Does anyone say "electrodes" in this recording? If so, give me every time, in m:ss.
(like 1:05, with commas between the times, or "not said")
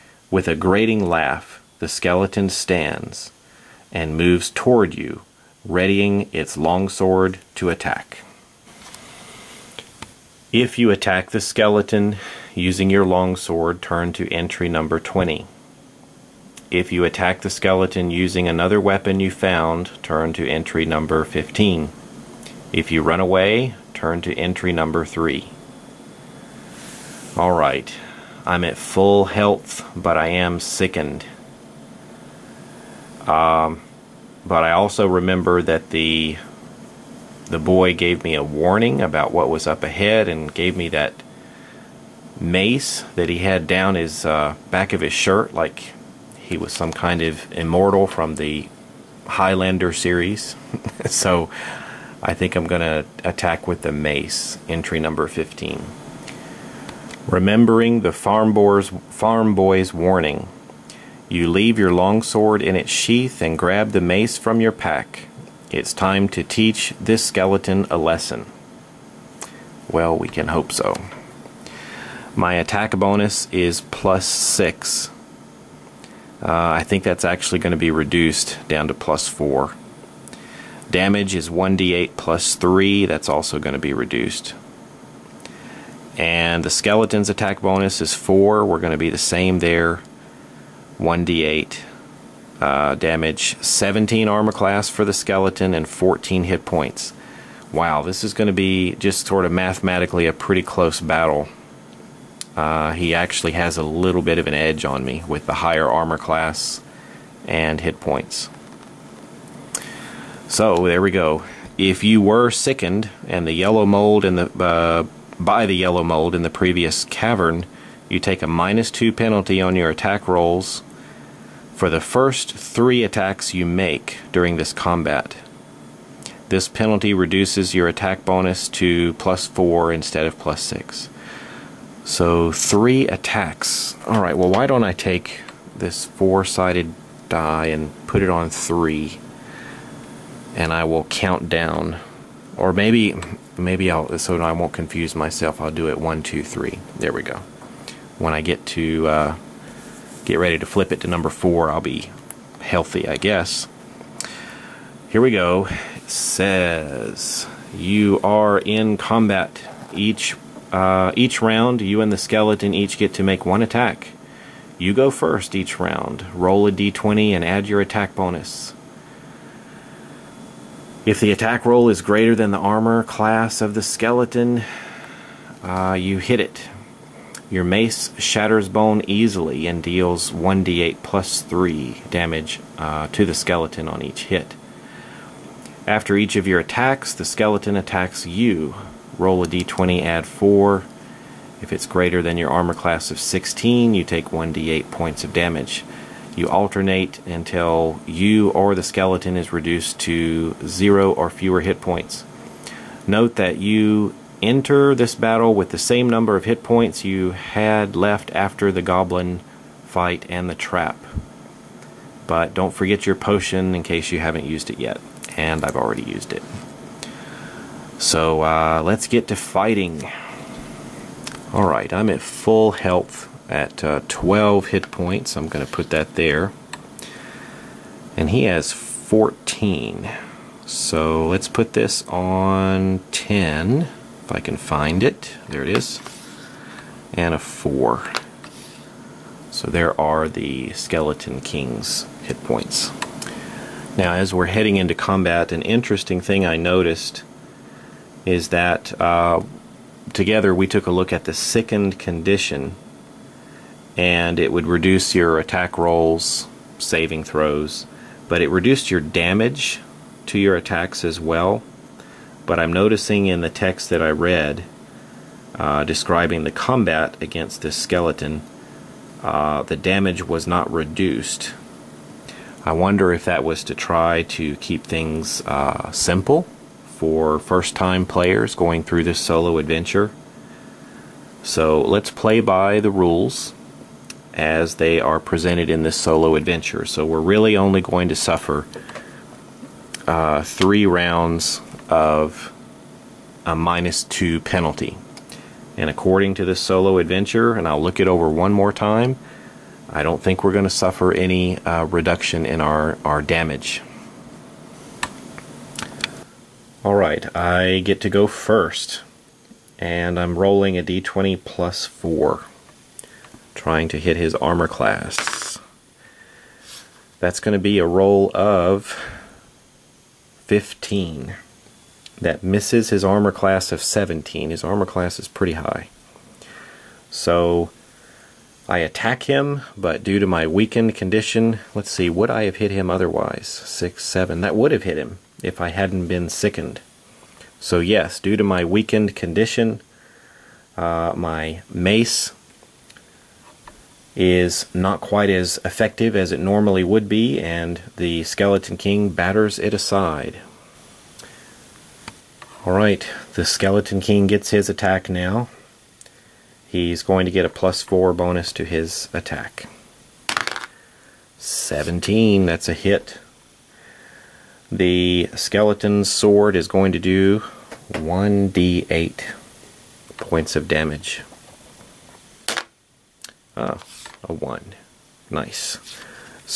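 not said.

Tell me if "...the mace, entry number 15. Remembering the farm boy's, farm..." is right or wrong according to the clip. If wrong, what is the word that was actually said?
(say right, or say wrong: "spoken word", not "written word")
right.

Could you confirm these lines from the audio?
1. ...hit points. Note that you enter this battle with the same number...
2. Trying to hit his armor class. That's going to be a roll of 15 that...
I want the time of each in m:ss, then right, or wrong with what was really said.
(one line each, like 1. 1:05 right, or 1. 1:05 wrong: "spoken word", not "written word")
1. 3:21 right
2. 5:13 right.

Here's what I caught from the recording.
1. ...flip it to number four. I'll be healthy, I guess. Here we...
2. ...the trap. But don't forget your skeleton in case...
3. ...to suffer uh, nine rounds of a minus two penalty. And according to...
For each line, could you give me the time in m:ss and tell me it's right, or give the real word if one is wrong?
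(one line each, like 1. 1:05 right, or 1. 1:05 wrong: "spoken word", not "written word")
1. 2:30 right
2. 3:30 wrong: "potion", not "skeleton"
3. 4:48 wrong: "three", not "nine".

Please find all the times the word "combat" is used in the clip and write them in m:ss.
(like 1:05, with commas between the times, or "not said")
2:04, 2:38, 4:04, 4:26.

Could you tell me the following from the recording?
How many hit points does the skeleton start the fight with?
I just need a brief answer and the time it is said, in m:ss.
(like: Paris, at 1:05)
14, at 1:35.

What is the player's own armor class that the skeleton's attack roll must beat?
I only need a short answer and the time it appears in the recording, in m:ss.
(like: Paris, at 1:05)
16, at 3:13.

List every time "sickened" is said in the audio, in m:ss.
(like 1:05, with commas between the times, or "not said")
0:30, 1:52, 4:11, 5:36.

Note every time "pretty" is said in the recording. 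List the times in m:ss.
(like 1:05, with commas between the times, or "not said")
1:40, 5:25.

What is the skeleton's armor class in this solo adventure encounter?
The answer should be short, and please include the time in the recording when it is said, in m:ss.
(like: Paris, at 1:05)
17, at 1:33.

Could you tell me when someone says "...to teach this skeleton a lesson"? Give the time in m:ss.
1:06.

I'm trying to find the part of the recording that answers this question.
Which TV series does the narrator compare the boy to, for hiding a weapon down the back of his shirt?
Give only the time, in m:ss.
0:49.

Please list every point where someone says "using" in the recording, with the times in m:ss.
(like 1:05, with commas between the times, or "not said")
0:12, 0:18.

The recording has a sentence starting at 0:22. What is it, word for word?
If you run away, turn to entry number 3.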